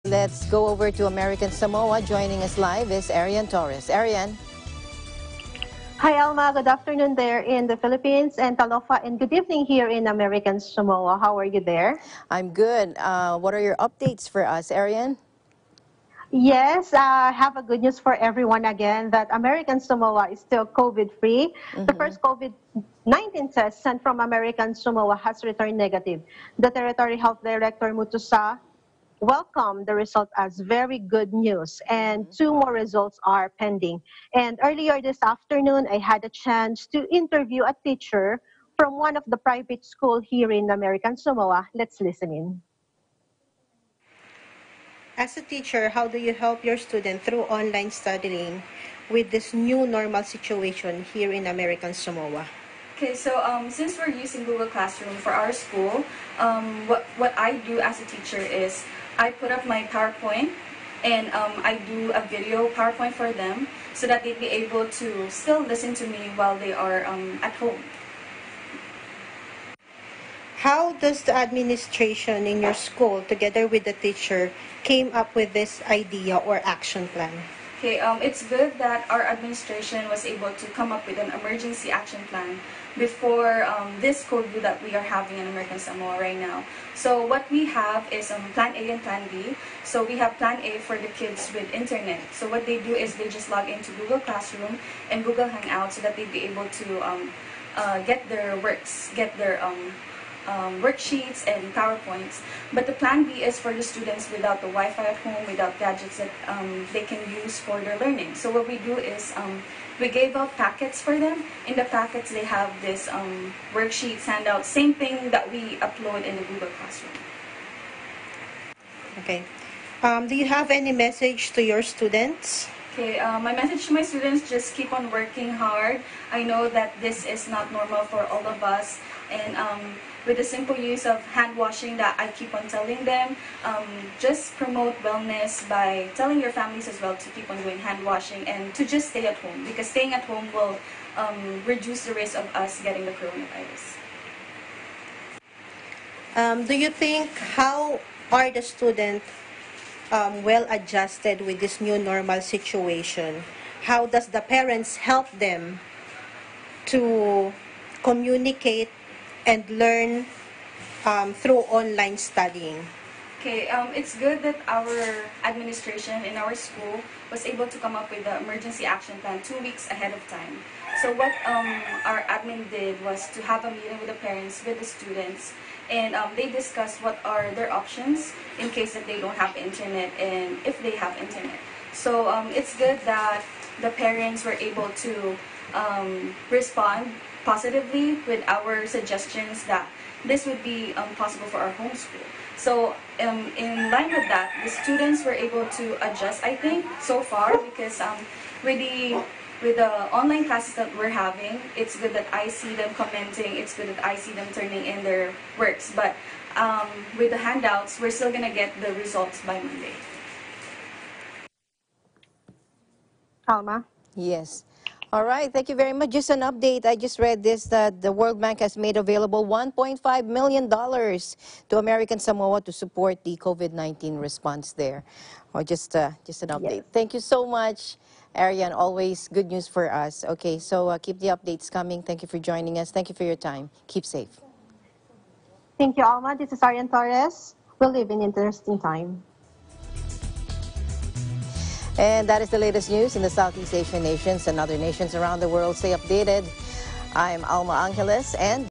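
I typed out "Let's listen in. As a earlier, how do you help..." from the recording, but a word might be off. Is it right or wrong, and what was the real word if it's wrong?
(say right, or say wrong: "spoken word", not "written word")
wrong: "teacher", not "earlier".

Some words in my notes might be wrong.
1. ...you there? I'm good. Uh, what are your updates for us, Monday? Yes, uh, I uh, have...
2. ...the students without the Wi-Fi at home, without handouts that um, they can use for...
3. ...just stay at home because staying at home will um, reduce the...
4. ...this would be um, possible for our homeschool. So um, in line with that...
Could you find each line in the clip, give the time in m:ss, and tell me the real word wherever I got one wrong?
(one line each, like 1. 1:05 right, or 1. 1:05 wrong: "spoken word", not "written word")
1. 0:11 wrong: "Arian", not "Monday"
2. 1:43 wrong: "gadgets", not "handouts"
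3. 2:18 right
4. 3:10 right.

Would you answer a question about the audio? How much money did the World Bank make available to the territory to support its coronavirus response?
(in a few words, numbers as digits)
$1.5 million.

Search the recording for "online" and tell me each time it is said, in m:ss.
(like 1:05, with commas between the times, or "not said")
0:47, 2:41, 3:20.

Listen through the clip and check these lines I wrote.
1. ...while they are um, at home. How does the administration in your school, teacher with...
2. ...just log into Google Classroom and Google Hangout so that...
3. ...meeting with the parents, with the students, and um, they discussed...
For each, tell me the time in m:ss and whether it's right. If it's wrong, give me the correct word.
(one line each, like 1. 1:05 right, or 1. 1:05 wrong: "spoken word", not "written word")
1. 1:06 wrong: "together", not "teacher"
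2. 1:33 right
3. 2:53 right.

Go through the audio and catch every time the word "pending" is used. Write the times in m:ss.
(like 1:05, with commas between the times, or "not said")
0:33.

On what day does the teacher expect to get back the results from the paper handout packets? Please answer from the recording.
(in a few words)
Monday.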